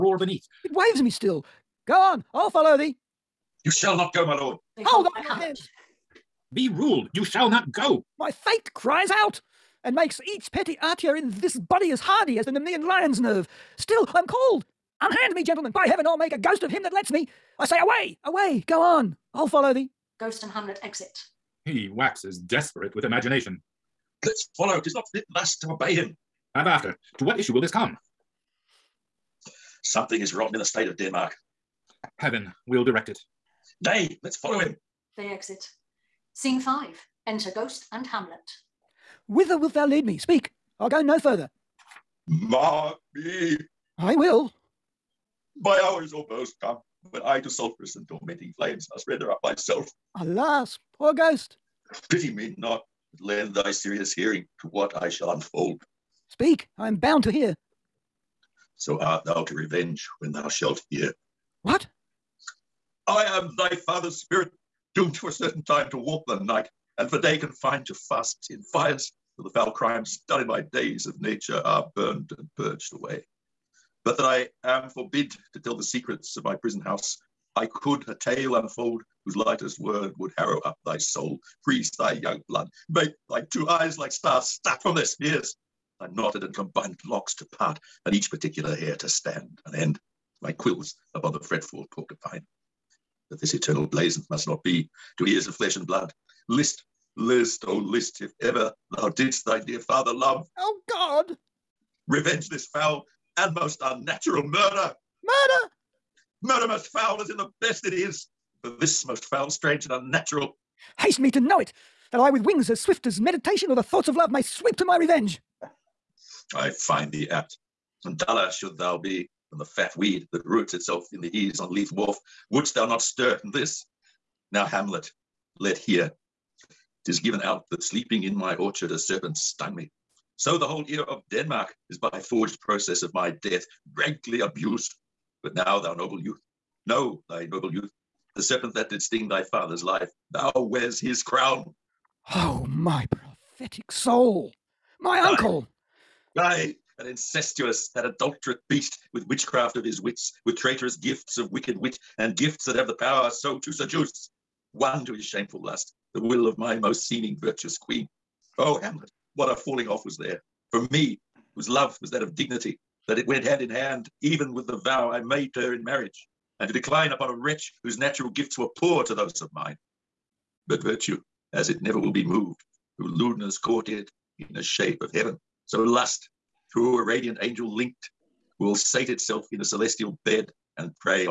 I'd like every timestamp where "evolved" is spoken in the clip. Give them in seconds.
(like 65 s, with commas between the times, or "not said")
not said.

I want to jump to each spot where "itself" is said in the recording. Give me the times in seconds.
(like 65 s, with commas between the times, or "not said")
120 s, 179 s.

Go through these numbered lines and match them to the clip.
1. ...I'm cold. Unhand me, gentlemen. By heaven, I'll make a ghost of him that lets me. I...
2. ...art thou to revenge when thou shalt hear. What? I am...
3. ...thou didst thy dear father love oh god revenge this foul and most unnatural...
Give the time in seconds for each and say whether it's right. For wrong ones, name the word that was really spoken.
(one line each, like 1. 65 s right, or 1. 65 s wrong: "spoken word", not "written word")
1. 14 s right
2. 58 s right
3. 98 s right.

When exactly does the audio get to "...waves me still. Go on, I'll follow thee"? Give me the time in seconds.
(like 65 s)
0 s.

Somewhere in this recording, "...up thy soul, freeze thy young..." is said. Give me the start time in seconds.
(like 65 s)
80 s.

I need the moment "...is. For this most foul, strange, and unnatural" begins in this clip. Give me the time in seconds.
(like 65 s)
107 s.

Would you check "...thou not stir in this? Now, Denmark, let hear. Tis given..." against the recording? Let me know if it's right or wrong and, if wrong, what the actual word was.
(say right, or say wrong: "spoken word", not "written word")
wrong: "Hamlet", not "Denmark".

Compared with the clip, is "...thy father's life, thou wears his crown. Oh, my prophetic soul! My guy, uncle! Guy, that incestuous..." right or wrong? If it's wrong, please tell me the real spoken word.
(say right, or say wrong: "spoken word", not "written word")
right.